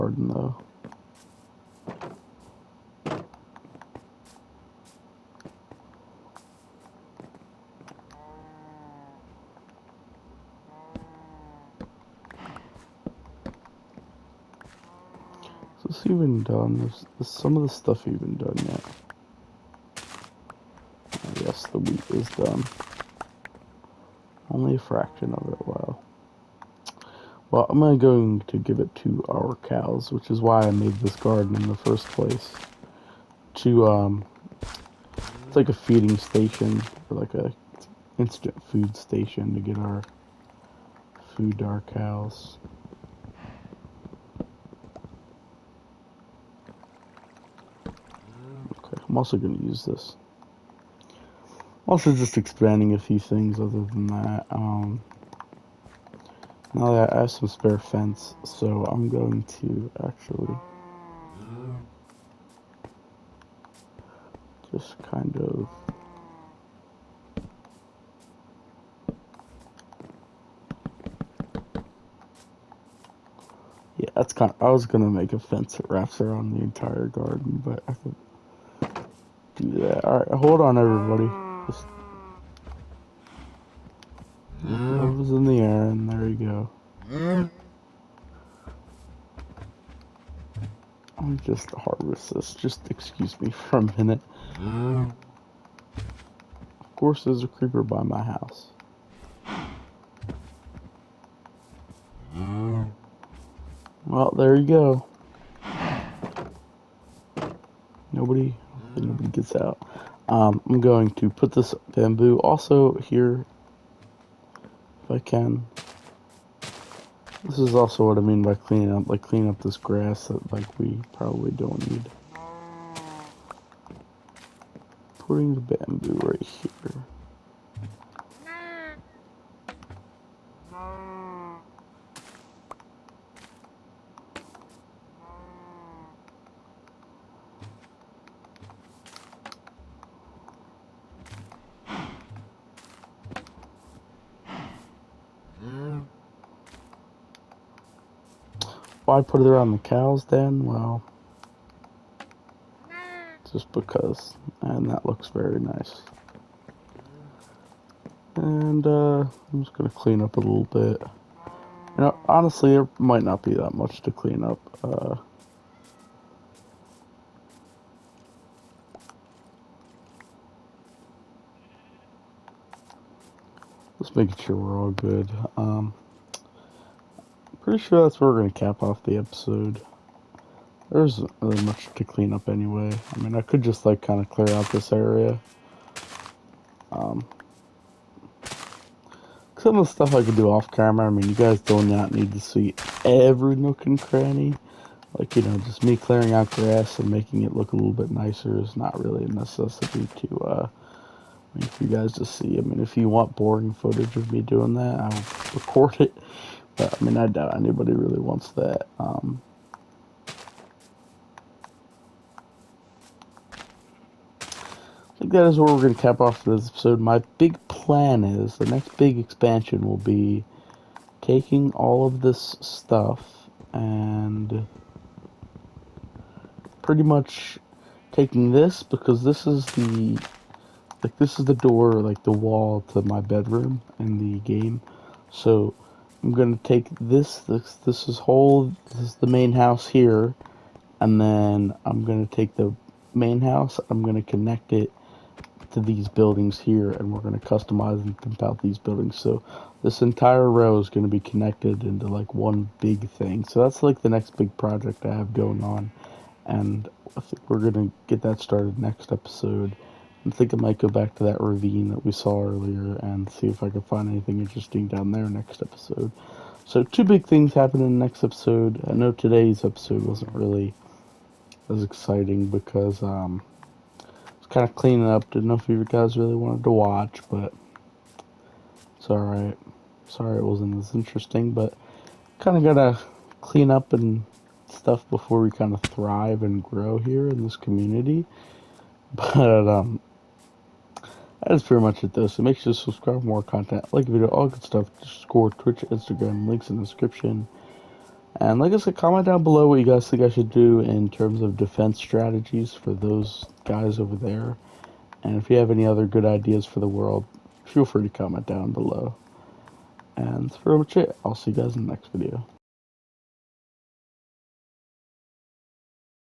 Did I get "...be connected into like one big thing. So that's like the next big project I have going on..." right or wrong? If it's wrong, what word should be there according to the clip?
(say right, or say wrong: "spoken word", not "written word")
right.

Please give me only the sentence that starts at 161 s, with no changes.
You know, honestly, there might not be that much to clean up.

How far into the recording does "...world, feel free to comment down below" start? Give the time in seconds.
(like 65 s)
306 s.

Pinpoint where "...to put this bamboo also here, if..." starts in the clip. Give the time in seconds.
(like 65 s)
111 s.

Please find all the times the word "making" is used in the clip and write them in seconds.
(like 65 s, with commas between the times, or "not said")
174 s, 197 s.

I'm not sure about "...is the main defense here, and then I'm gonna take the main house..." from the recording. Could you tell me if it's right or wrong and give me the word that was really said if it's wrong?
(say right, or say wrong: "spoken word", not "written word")
wrong: "house", not "defense".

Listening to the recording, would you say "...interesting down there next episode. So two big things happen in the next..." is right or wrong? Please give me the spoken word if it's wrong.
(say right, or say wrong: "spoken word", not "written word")
right.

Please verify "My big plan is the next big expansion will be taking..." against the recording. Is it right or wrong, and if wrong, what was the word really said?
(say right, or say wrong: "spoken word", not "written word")
right.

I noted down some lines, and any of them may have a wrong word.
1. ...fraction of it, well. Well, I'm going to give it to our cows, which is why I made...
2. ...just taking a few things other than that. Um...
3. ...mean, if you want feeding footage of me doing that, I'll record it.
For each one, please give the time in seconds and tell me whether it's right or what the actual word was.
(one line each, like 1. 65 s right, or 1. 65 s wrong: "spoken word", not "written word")
1. 24 s right
2. 52 s wrong: "expanding", not "taking"
3. 202 s wrong: "boring", not "feeding".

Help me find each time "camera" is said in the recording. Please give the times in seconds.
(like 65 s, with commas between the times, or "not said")
190 s.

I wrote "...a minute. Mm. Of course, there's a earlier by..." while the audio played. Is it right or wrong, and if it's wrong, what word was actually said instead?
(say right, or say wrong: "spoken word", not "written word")
wrong: "creeper", not "earlier".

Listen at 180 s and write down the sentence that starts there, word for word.
There really much to clean up anyway.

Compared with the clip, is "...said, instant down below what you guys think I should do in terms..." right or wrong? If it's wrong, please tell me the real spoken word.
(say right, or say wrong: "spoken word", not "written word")
wrong: "comment", not "instant".